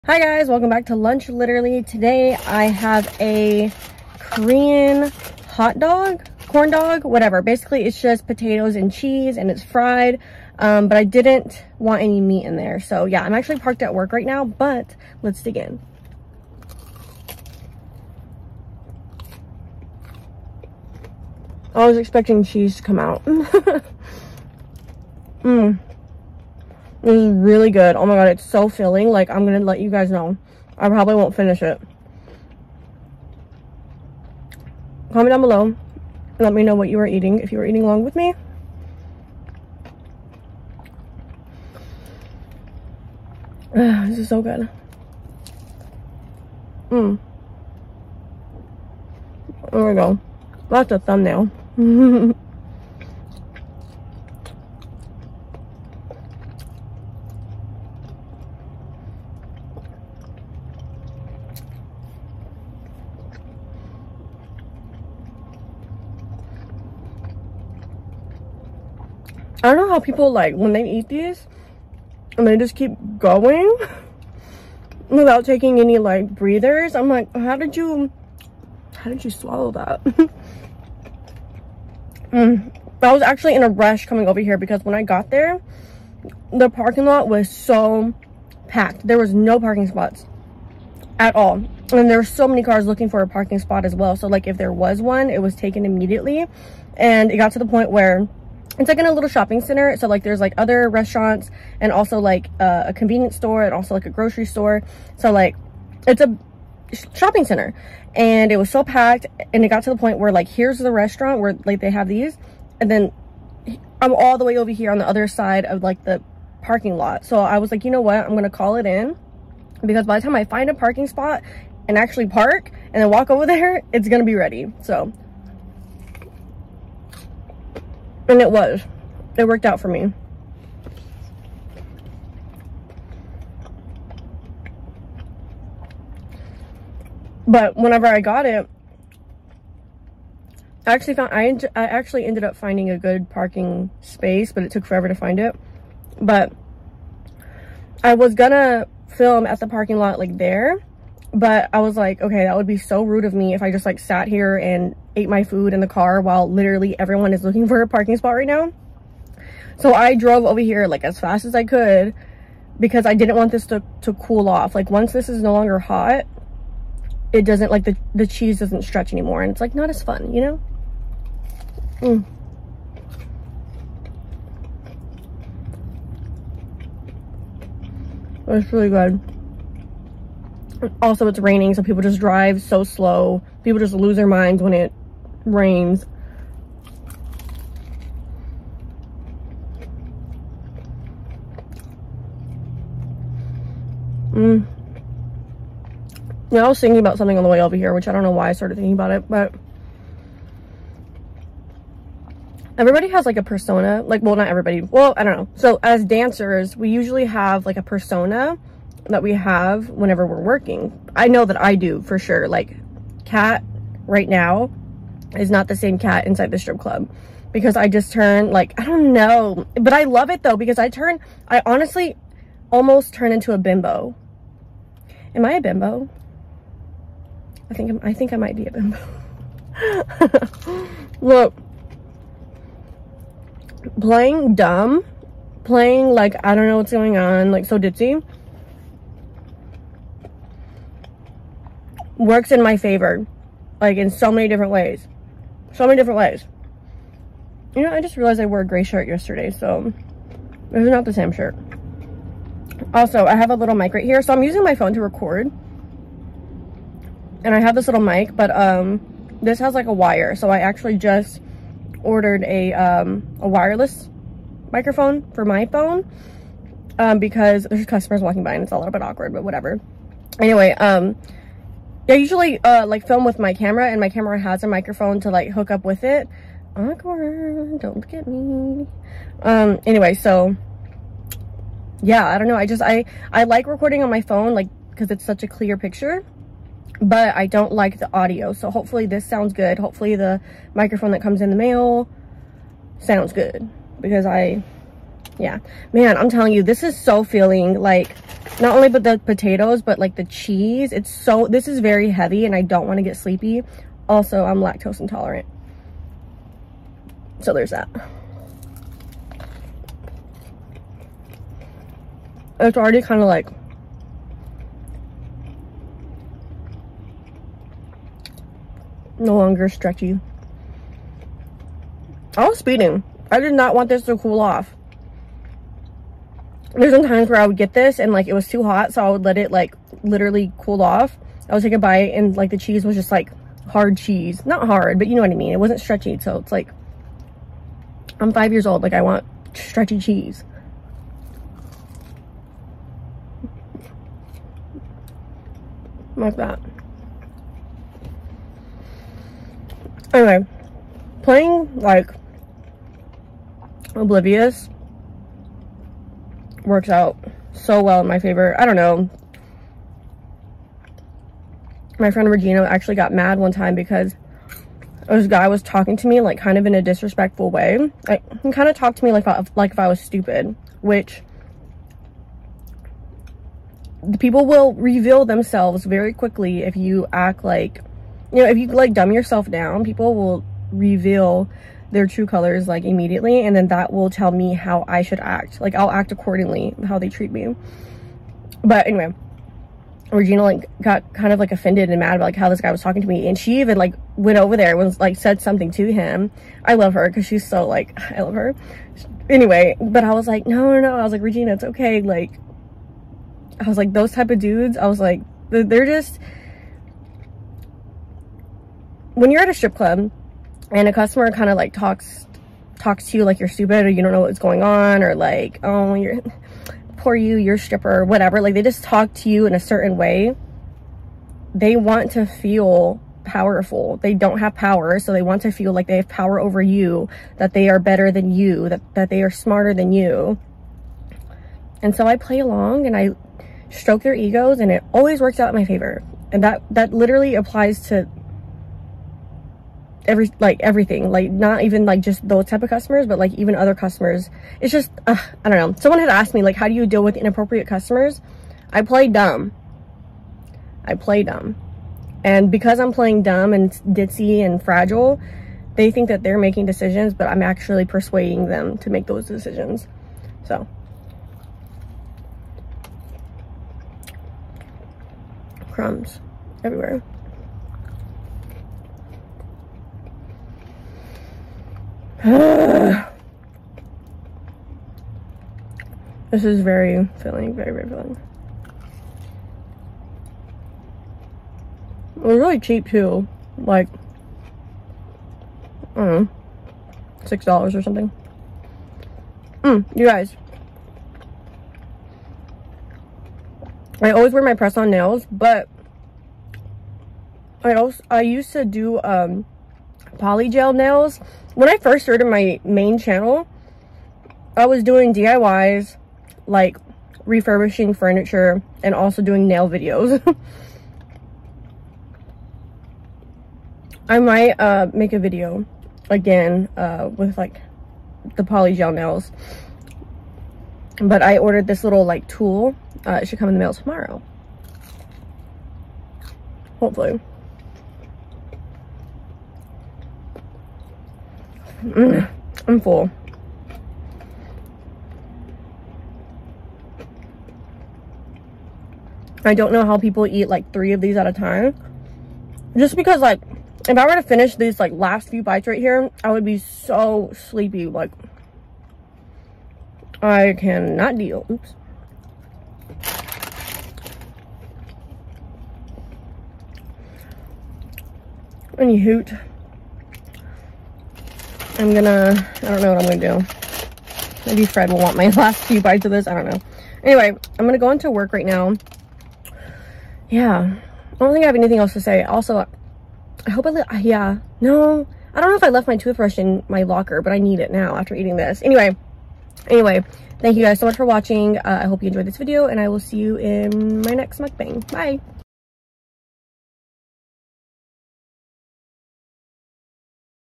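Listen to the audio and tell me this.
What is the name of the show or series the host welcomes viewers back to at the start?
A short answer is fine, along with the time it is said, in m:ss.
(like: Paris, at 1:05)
Lunch Literally, at 0:00.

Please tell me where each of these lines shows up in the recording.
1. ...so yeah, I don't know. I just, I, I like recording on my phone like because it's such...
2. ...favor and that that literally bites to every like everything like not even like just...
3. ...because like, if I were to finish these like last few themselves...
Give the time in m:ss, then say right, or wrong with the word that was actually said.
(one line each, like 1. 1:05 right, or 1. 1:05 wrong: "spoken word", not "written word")
1. 4:40 right
2. 7:15 wrong: "applies", not "bites"
3. 9:02 wrong: "bites", not "themselves".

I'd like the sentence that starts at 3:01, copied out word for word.
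Also, it's raining, so people just drive so slow.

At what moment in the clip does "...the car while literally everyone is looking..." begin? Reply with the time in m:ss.
2:35.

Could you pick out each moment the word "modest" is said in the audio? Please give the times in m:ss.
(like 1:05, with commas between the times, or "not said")
not said.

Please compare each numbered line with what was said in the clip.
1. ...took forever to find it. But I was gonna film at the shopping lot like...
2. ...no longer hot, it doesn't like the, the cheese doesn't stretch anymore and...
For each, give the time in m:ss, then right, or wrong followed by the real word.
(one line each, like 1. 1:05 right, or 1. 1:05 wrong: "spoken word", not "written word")
1. 2:24 wrong: "parking", not "shopping"
2. 2:45 right.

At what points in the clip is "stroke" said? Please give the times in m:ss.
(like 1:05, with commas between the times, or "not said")
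7:13.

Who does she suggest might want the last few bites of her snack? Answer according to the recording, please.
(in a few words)
Fred.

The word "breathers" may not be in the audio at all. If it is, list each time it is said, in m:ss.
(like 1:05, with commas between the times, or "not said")
1:16.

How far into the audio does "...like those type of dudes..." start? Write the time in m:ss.
6:43.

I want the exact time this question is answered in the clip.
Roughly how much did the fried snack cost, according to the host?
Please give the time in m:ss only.
8:07.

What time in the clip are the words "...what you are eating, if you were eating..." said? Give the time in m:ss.
0:36.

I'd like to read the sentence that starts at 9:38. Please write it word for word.
Anyway, anyway, thank you guys so much for watching.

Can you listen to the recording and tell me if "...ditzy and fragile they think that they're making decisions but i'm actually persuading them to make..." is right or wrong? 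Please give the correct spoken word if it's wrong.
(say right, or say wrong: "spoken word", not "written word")
right.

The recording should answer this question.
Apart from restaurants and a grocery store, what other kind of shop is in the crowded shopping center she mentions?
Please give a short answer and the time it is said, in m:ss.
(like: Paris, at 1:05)
Convenience store, at 1:42.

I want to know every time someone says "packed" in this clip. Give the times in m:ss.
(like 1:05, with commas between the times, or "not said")
1:28, 1:48.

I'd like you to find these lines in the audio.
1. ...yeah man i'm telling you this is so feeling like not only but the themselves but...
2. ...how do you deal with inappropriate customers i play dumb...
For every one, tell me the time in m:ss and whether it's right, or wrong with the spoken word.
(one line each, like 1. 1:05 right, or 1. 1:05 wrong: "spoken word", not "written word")
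1. 4:55 wrong: "potatoes", not "themselves"
2. 7:26 right.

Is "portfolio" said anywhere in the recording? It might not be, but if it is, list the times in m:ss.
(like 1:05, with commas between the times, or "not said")
not said.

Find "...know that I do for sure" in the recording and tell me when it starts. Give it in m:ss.
3:31.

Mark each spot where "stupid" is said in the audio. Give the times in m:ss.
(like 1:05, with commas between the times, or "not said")
6:09, 6:53.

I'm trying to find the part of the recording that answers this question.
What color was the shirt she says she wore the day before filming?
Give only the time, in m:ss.
4:08.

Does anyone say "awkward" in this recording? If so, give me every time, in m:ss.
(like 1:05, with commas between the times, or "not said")
4:29, 4:36.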